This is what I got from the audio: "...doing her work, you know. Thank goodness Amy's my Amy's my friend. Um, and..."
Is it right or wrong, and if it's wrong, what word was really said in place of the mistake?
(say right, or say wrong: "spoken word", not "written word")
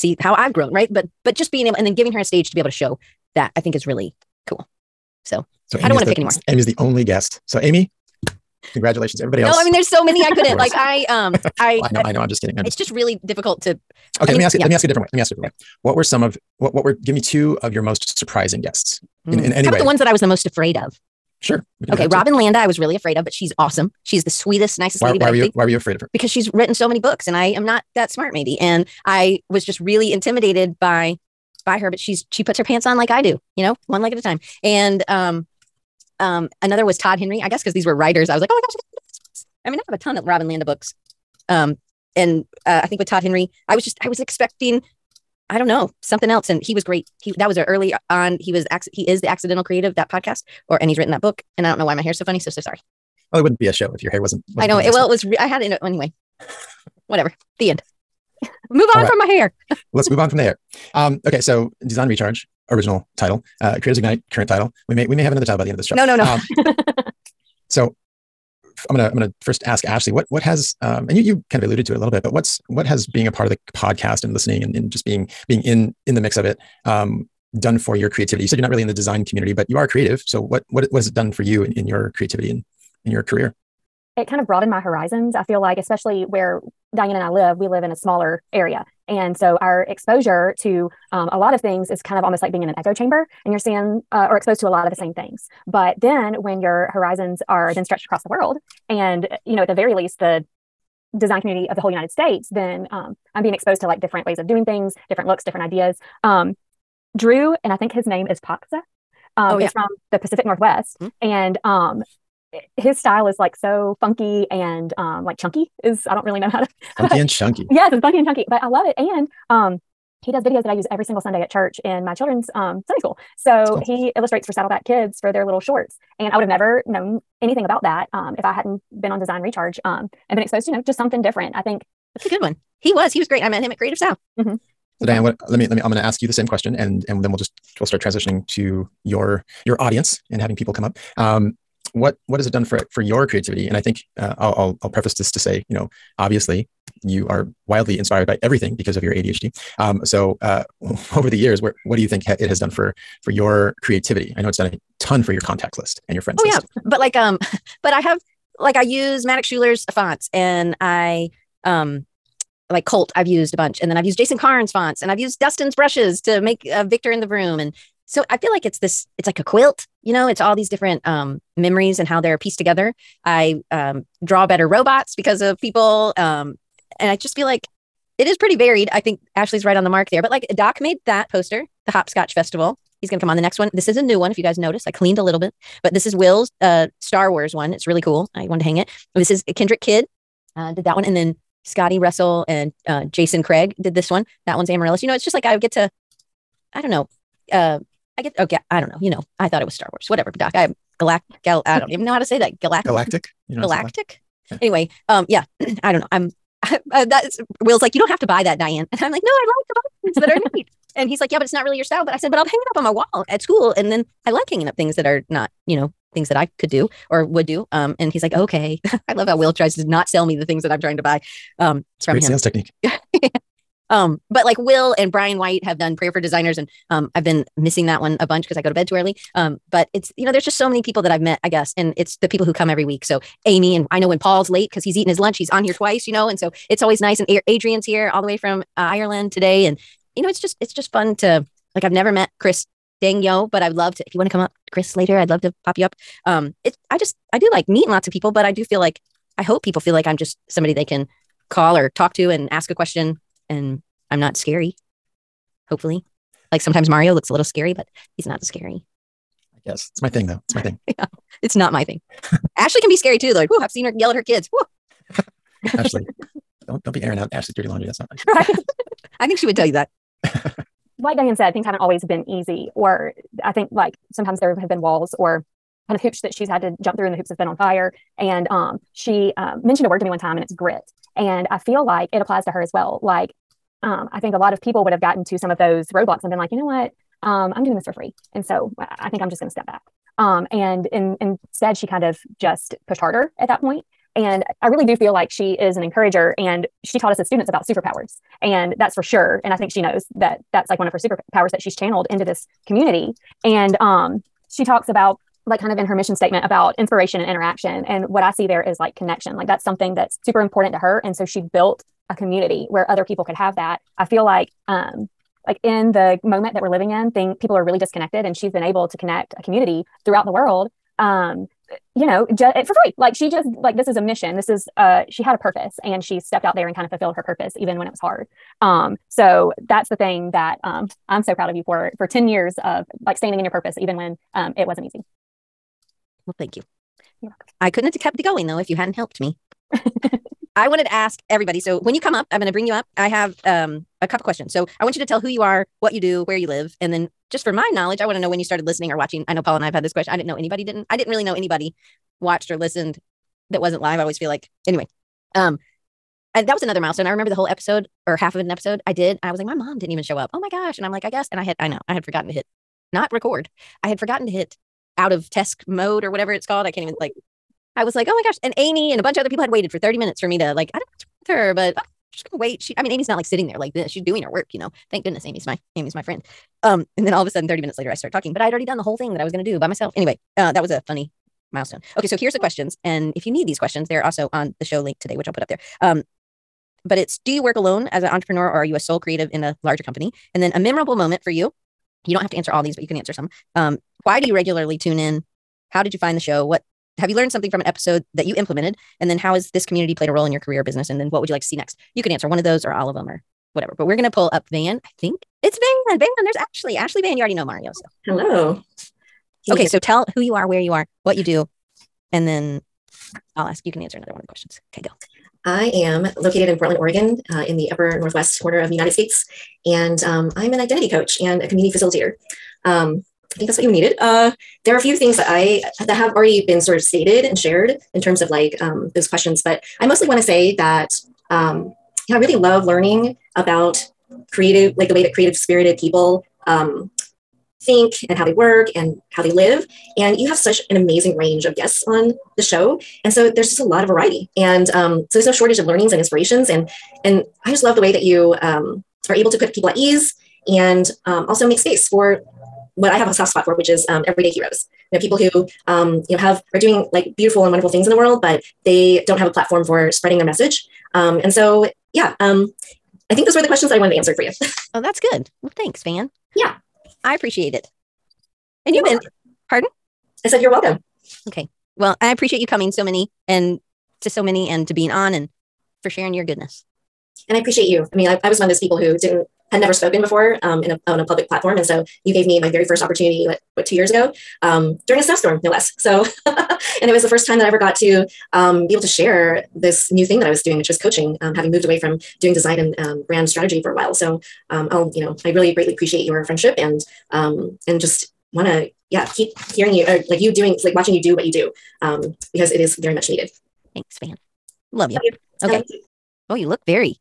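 right.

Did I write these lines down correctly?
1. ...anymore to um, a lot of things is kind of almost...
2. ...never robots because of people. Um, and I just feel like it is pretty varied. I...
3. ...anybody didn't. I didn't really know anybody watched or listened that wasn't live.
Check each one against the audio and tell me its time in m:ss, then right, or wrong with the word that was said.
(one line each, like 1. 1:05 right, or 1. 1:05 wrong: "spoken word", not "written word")
1. 1:29 wrong: "exposure", not "anymore"
2. 2:54 wrong: "better", not "never"
3. 5:50 right.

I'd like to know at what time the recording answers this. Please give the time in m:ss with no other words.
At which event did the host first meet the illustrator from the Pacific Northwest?
2:13.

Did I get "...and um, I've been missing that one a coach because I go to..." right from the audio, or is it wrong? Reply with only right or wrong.
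wrong.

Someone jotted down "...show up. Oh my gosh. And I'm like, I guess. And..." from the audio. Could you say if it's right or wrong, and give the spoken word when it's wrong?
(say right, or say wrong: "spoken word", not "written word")
right.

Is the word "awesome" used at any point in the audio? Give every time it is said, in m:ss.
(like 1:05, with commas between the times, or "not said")
0:23.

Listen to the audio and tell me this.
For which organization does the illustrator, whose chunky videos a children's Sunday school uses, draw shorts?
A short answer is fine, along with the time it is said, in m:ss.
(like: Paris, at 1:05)
Saddleback kids, at 2:04.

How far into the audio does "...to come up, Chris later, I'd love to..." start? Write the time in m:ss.
4:04.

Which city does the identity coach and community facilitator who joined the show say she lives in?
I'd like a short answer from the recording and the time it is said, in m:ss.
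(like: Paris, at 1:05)
Portland, Oregon, at 6:56.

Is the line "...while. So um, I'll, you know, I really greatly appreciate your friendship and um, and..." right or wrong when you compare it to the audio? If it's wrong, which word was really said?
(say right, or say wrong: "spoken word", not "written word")
right.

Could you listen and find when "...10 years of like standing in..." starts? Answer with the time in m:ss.
5:32.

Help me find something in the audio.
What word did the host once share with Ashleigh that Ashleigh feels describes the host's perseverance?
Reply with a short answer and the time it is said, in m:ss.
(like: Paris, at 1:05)
Grit, at 4:40.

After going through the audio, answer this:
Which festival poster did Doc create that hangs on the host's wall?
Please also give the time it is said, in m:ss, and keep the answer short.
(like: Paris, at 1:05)
Hopscotch Festival, at 3:01.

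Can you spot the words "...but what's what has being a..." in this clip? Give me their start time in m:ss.
1:12.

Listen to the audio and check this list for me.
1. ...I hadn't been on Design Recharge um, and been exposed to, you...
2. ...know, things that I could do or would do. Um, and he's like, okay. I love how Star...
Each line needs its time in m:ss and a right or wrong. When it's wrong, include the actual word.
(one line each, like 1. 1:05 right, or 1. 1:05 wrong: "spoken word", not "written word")
1. 2:08 right
2. 3:35 wrong: "Will", not "Star".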